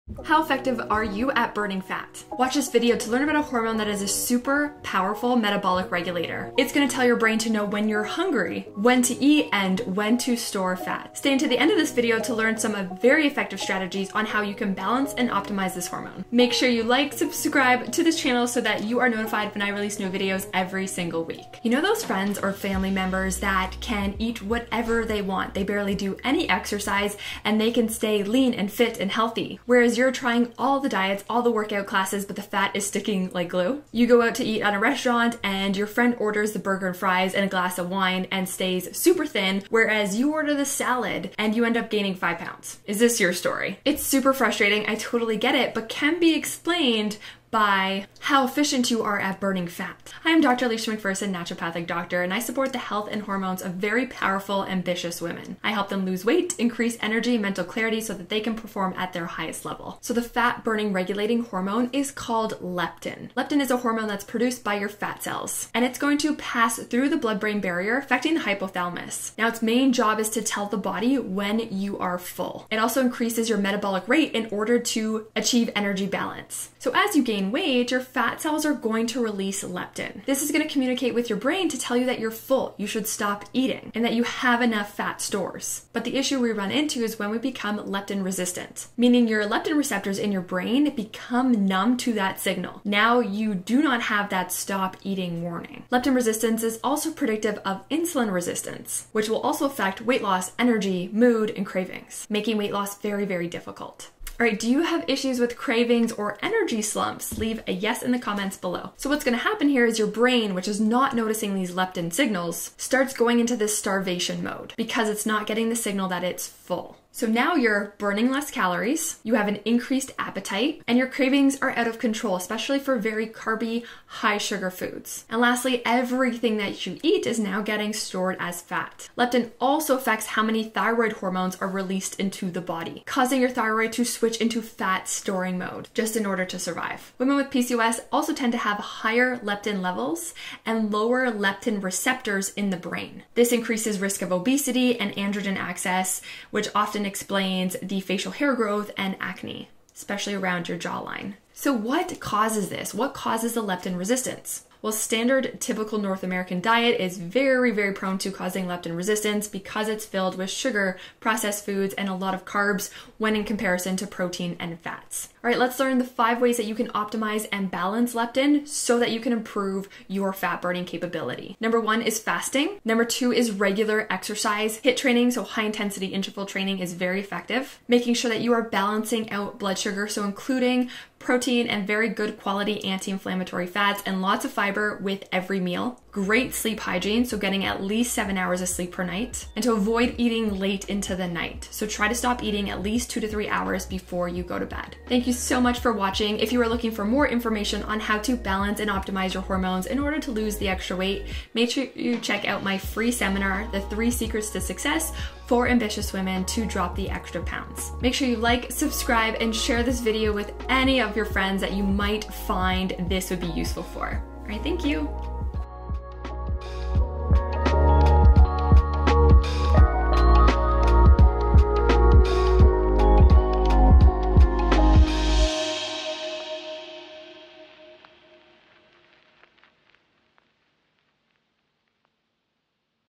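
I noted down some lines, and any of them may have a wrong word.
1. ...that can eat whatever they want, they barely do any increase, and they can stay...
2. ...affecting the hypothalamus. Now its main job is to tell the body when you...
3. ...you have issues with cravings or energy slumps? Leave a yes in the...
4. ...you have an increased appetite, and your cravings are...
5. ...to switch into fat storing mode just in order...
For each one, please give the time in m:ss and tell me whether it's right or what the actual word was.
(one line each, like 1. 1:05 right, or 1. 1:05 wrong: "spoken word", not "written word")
1. 0:23 wrong: "exercise", not "increase"
2. 1:07 right
3. 1:44 right
4. 1:59 right
5. 2:13 right.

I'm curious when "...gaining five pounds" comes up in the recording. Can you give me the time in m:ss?
0:41.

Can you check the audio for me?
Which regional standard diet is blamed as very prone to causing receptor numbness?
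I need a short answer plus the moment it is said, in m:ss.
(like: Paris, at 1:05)
North American, at 2:35.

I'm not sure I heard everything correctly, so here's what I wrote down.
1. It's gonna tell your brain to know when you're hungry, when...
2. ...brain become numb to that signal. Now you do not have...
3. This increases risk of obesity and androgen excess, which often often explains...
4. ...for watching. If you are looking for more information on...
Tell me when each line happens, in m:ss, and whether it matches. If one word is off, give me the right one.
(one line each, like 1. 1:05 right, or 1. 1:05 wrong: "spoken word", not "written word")
1. 0:06 right
2. 1:30 right
3. 2:23 right
4. 3:15 right.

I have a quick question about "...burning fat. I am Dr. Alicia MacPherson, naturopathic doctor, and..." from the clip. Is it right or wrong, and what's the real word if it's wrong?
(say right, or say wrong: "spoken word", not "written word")
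right.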